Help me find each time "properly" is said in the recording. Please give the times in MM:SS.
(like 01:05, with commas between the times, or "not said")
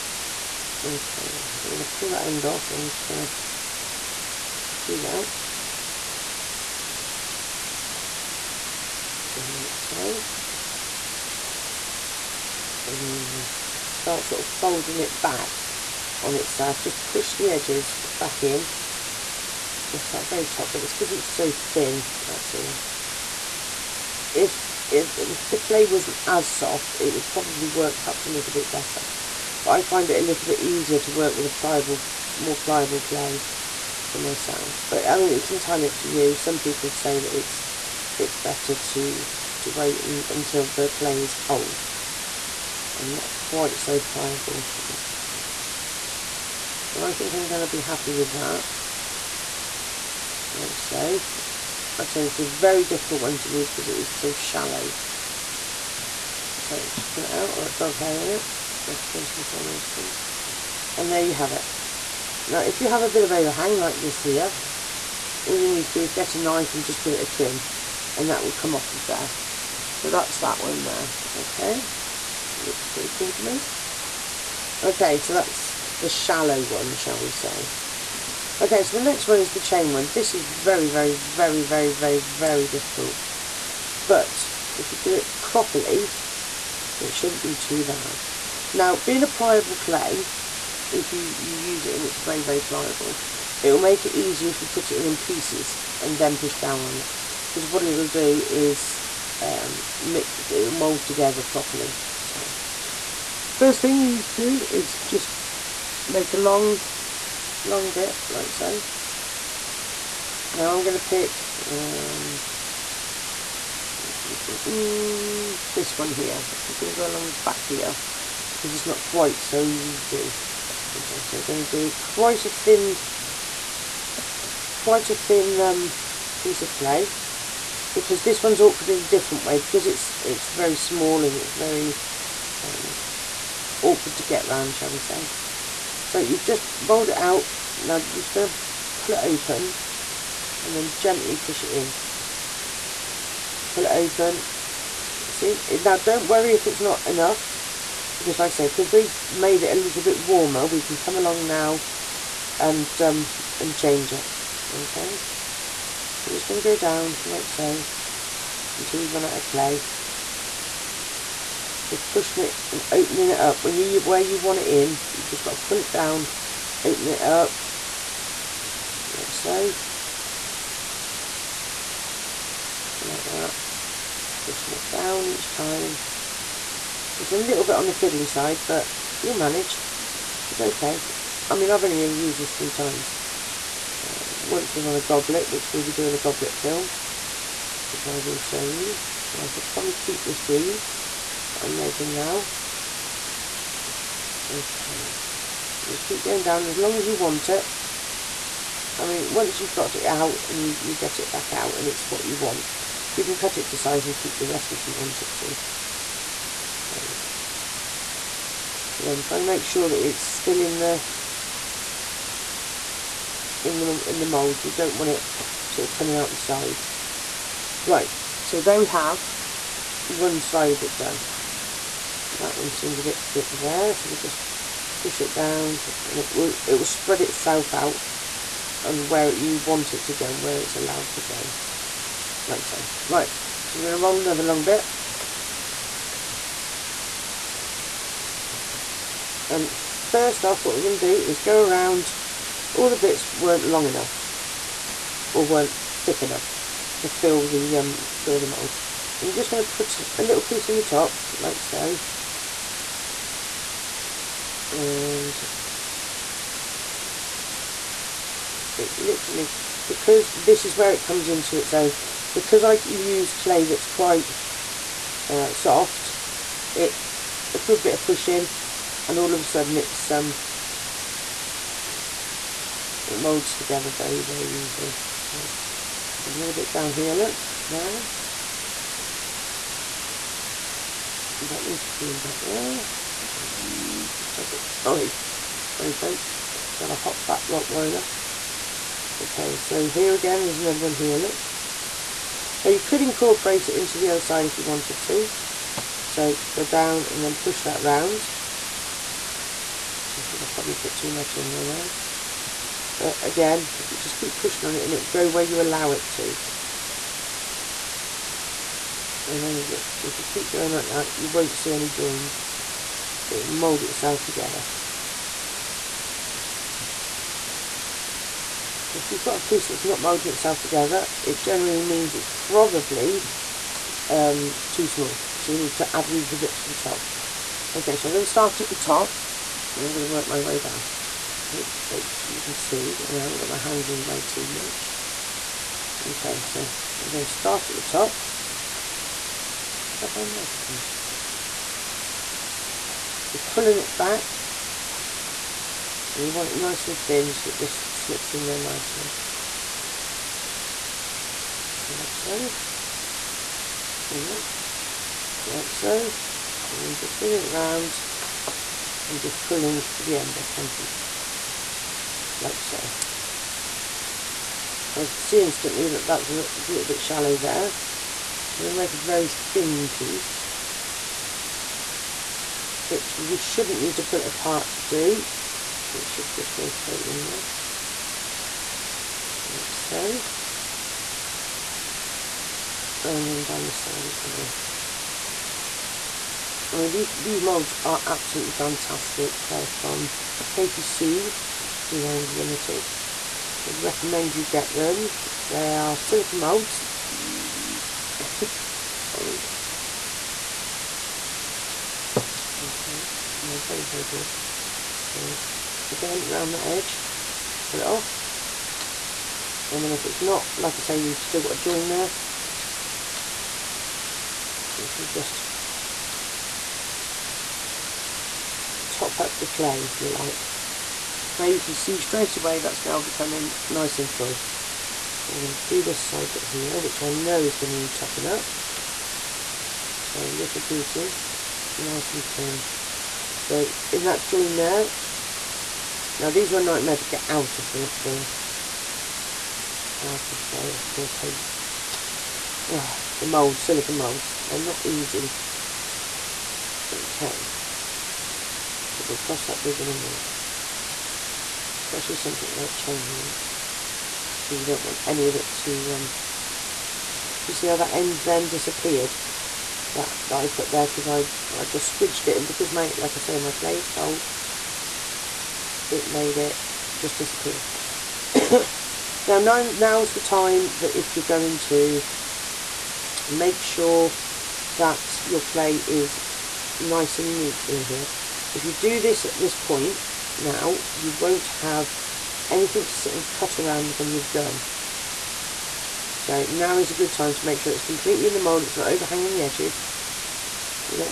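01:25, 01:41.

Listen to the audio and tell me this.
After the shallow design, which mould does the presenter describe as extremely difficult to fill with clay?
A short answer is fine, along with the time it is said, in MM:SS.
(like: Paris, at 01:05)
the chain one, at 01:19.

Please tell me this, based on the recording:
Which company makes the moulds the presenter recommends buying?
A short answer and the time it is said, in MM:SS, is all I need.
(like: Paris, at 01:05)
Katy Sue Designs Limited, at 06:30.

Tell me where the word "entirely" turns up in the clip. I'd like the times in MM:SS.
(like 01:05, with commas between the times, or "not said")
00:35.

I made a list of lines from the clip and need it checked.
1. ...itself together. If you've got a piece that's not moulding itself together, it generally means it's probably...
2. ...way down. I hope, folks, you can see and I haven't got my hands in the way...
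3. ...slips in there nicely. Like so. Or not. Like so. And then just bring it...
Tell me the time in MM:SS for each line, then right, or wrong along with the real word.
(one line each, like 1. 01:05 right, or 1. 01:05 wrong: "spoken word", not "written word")
1. 05:13 right
2. 05:30 right
3. 05:47 right.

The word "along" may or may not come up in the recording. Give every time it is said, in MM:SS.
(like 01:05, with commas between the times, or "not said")
01:57, 02:31.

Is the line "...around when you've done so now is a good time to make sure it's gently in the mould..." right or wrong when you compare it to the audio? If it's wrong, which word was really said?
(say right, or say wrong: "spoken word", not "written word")
wrong: "completely", not "gently".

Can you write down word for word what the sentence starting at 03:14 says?
Okay, so just keep going down as long as you want it.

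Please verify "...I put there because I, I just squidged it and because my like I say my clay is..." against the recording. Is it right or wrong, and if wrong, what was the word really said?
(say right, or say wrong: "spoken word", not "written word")
right.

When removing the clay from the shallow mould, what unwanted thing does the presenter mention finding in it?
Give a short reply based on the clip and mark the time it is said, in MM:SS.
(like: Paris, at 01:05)
dog hair, at 00:57.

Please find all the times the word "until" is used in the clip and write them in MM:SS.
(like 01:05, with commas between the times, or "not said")
00:40, 02:38.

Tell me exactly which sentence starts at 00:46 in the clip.
So I think I'm going to be happy with that.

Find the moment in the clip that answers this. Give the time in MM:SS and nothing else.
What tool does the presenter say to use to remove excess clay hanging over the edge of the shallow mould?
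01:06.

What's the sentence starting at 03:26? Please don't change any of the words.
So, again, trying to make sure that it's still in the in the in the mould.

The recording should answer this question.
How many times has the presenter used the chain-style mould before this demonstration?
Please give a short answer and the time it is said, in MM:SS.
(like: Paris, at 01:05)
3, at 03:02.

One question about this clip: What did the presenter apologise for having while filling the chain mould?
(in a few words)
a hot fat roller.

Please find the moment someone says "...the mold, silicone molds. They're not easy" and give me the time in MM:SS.
07:23.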